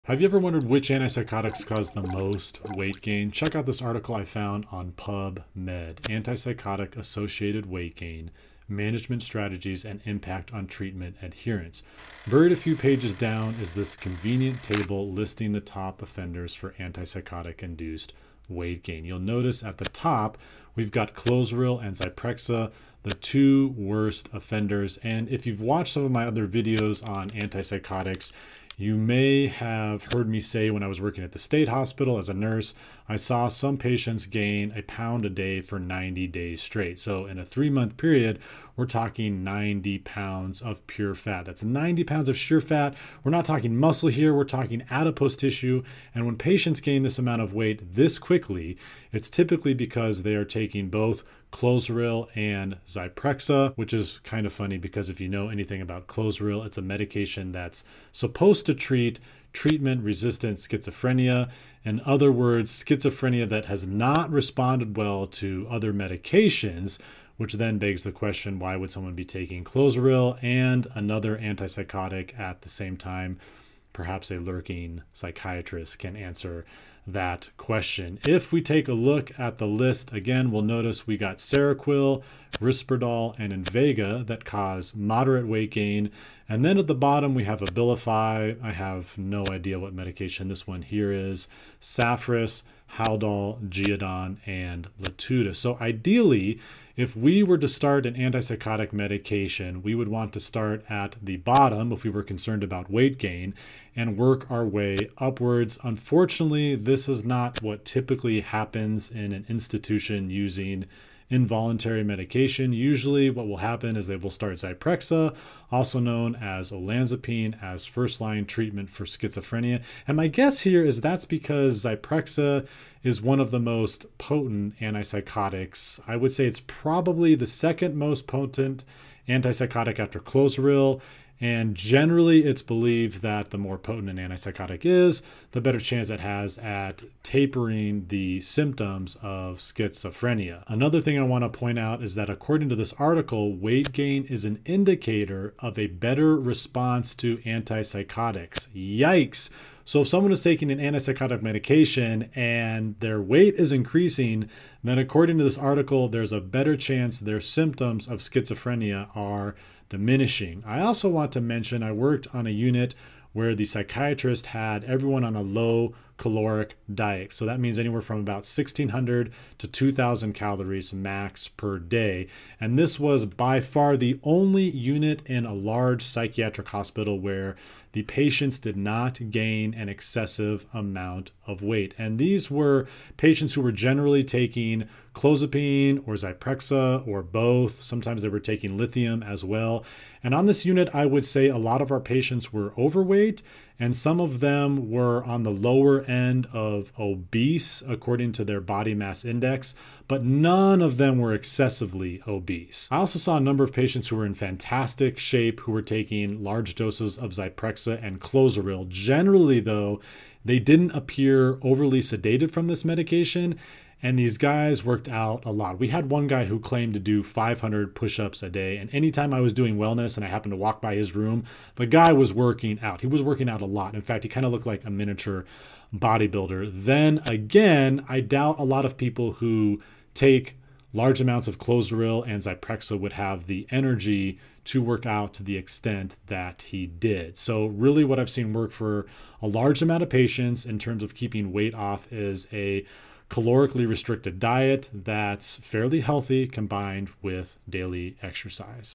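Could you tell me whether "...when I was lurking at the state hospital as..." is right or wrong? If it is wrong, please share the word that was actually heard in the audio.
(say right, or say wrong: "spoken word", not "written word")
wrong: "working", not "lurking".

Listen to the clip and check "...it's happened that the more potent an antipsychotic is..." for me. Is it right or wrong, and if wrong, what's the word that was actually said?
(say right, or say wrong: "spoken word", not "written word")
wrong: "believed", not "happened".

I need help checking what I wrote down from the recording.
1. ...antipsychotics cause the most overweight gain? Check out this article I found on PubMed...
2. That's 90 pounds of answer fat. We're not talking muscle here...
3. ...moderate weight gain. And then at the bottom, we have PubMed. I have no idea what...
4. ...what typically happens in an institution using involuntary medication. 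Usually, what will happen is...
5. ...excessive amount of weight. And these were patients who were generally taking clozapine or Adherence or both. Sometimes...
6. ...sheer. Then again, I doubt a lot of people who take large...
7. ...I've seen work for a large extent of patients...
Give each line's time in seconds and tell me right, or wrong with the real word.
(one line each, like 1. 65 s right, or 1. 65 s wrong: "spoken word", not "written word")
1. 0 s wrong: "weight", not "overweight"
2. 41 s wrong: "sheer", not "answer"
3. 84 s wrong: "Abilify", not "PubMed"
4. 107 s right
5. 179 s wrong: "Zyprexa", not "Adherence"
6. 225 s wrong: "bodybuilder", not "sheer"
7. 238 s wrong: "amount", not "extent".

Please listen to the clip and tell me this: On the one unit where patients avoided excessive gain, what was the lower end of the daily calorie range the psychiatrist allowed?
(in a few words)
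1,600.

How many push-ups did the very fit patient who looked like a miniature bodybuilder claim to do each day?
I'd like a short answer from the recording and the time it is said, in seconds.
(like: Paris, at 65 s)
500, at 217 s.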